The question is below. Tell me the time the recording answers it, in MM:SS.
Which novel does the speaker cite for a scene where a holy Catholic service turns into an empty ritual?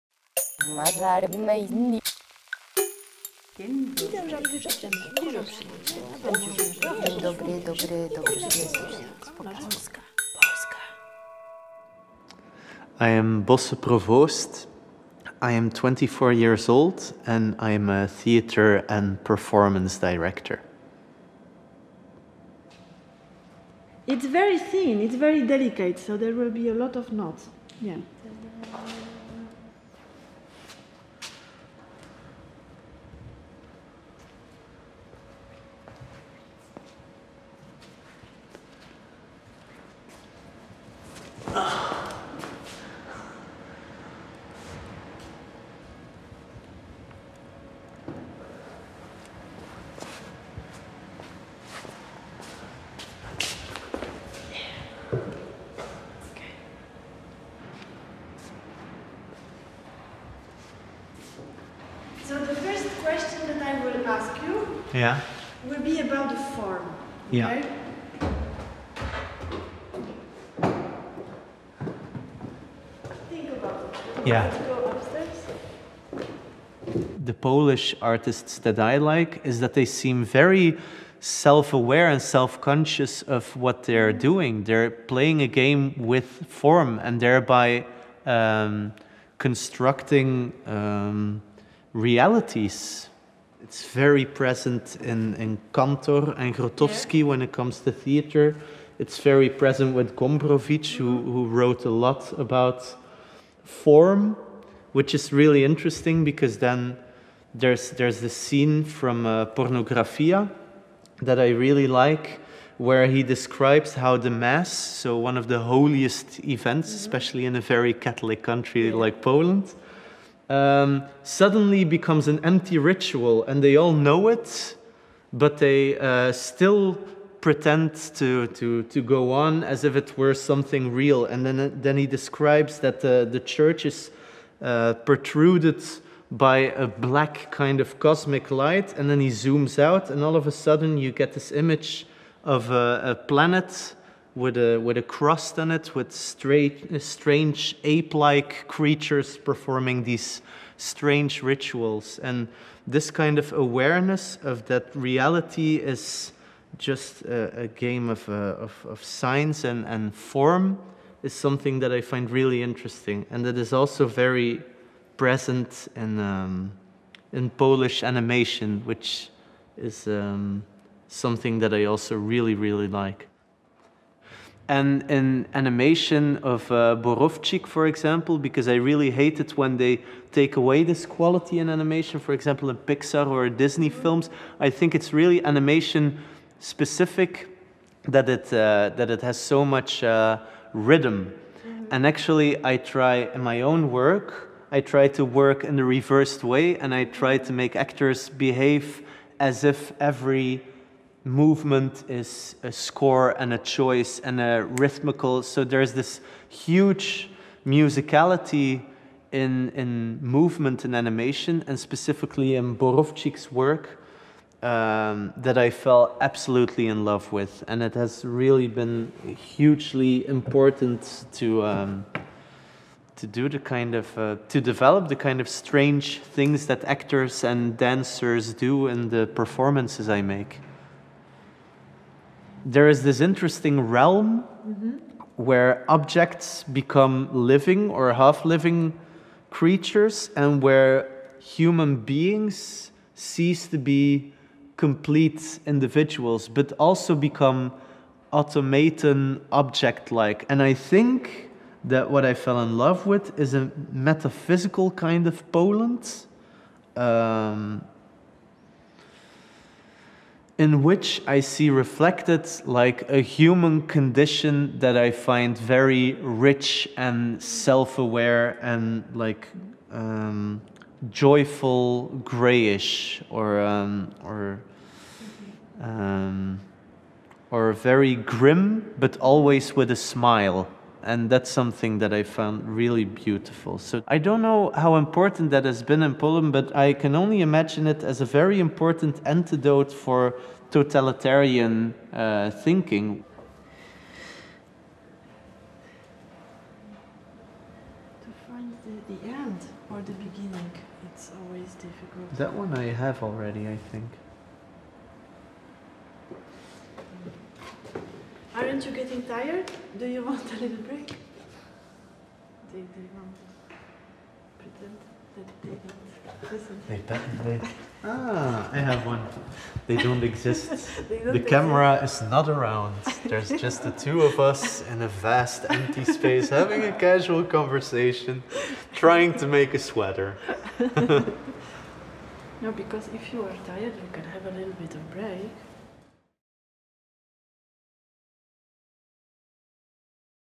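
01:49.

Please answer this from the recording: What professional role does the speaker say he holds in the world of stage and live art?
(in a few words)
theater and performance director.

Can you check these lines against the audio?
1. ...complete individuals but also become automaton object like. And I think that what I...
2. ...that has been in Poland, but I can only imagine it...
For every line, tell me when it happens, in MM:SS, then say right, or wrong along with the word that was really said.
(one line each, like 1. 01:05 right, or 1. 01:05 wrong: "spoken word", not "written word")
1. 04:04 right
2. 04:45 right.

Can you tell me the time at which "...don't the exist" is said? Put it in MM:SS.
05:21.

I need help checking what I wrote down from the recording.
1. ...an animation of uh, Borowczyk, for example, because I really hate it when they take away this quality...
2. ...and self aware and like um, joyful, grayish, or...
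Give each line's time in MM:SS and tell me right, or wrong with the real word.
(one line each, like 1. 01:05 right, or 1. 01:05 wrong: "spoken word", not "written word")
1. 02:55 right
2. 04:26 right.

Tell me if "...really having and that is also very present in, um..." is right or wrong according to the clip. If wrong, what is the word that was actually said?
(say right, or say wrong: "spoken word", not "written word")
wrong: "interesting", not "having".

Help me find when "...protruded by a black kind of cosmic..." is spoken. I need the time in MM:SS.
02:15.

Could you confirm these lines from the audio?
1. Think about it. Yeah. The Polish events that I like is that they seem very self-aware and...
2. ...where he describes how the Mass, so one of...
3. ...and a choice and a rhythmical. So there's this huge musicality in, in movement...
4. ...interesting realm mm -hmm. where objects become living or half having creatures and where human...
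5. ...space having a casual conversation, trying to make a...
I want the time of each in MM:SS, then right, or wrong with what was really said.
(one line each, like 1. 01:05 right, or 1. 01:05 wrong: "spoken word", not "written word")
1. 01:13 wrong: "artists", not "events"
2. 01:52 right
3. 03:23 right
4. 03:53 wrong: "living", not "having"
5. 05:26 right.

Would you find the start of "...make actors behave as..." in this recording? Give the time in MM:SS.
03:17.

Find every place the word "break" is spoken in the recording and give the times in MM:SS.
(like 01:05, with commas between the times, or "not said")
05:10, 05:35.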